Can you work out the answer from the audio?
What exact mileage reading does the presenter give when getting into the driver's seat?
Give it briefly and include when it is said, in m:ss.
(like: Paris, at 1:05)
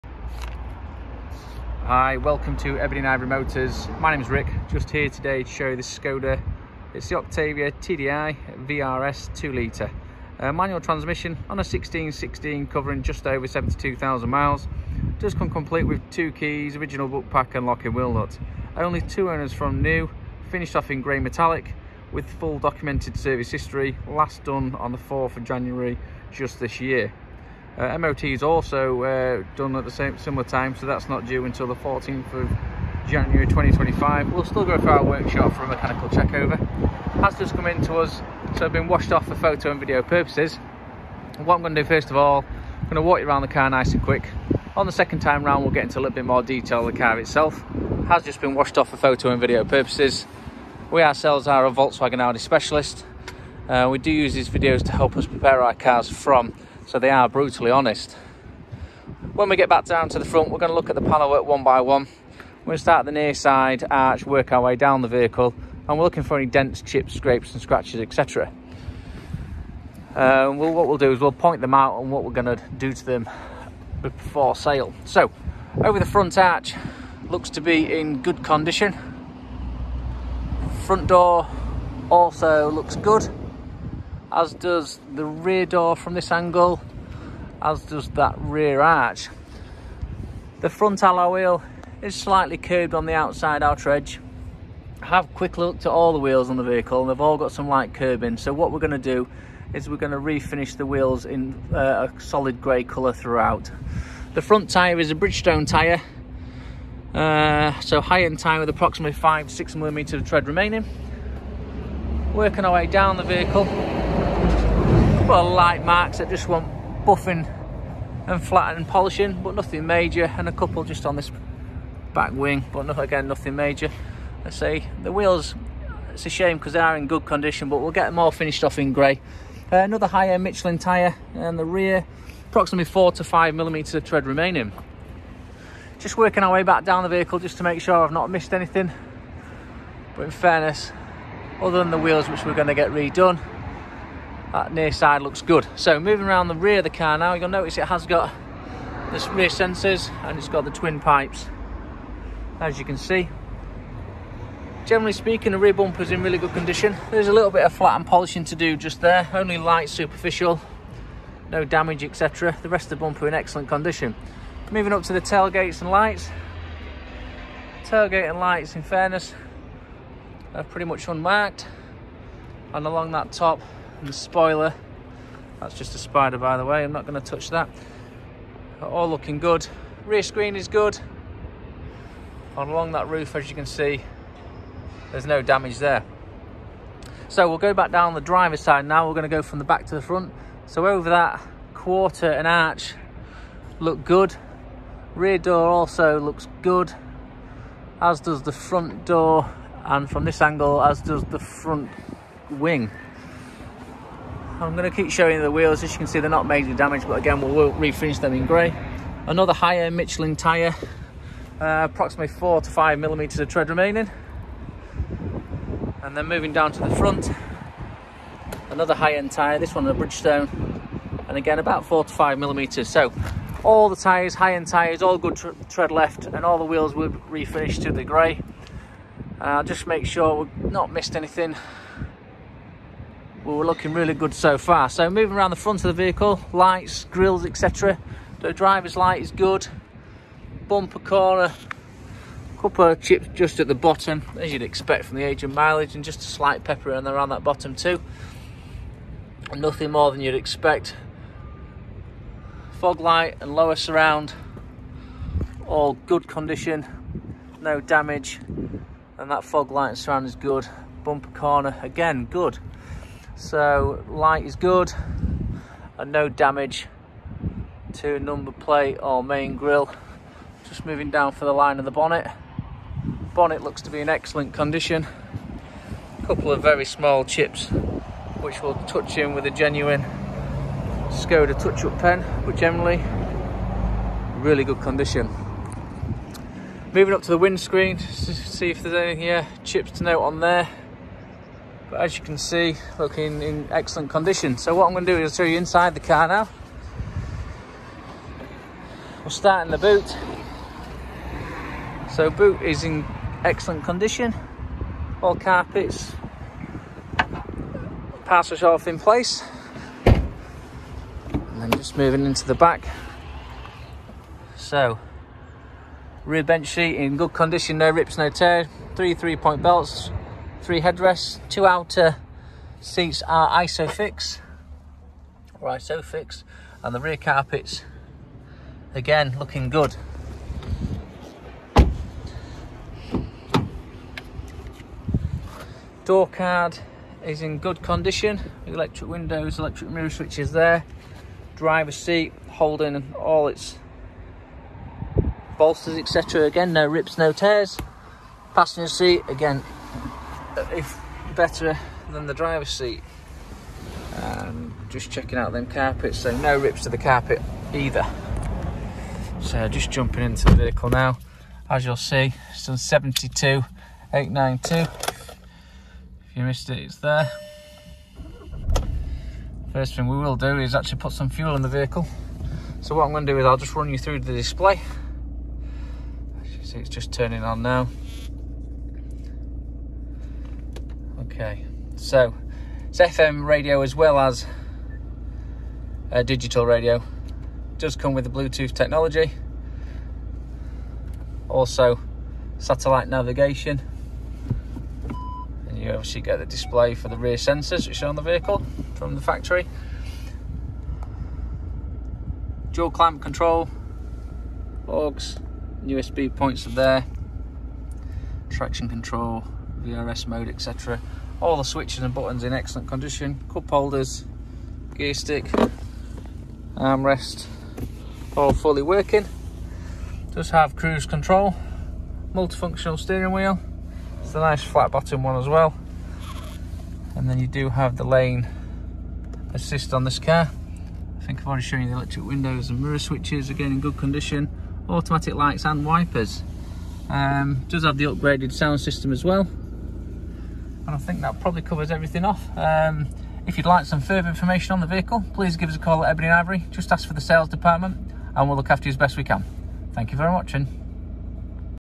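72,892, at 6:02.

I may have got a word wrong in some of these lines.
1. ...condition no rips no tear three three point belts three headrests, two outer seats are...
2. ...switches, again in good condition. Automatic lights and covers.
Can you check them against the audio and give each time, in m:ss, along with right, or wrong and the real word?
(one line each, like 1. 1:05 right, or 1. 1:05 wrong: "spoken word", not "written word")
1. 5:17 right
2. 7:12 wrong: "wipers", not "covers".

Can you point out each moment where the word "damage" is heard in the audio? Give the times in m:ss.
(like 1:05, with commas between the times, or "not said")
2:41, 3:05, 3:26, 4:17, 4:26.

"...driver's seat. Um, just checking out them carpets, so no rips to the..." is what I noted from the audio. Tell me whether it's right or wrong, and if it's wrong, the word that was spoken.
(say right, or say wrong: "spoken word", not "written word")
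right.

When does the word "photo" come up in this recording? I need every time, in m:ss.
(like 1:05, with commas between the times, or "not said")
0:39, 0:48.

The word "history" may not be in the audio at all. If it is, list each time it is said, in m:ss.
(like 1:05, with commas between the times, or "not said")
0:23.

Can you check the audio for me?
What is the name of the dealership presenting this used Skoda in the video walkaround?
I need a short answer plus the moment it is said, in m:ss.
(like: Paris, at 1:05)
Ebony and Ivory Motors, at 0:02.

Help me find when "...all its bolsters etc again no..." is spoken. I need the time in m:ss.
5:43.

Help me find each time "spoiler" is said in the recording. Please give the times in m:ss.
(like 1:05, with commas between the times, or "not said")
2:54.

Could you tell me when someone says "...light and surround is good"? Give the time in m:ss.
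4:19.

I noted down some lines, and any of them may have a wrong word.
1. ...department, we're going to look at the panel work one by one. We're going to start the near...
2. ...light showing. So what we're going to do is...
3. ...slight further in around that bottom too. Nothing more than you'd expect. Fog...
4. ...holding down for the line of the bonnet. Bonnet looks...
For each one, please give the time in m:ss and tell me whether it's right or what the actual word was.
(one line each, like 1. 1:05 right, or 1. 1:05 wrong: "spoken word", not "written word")
1. 1:00 wrong: "front", not "department"
2. 1:37 wrong: "curbing", not "showing"
3. 4:06 wrong: "pepper", not "further"
4. 4:30 wrong: "moving", not "holding".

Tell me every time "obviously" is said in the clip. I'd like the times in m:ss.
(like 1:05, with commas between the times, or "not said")
6:35.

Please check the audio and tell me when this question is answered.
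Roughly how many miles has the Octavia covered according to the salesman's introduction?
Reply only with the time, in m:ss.
0:13.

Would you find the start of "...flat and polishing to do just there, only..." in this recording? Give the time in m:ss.
2:37.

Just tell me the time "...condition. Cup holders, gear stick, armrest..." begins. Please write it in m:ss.
6:52.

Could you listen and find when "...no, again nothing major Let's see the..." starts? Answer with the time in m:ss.
2:02.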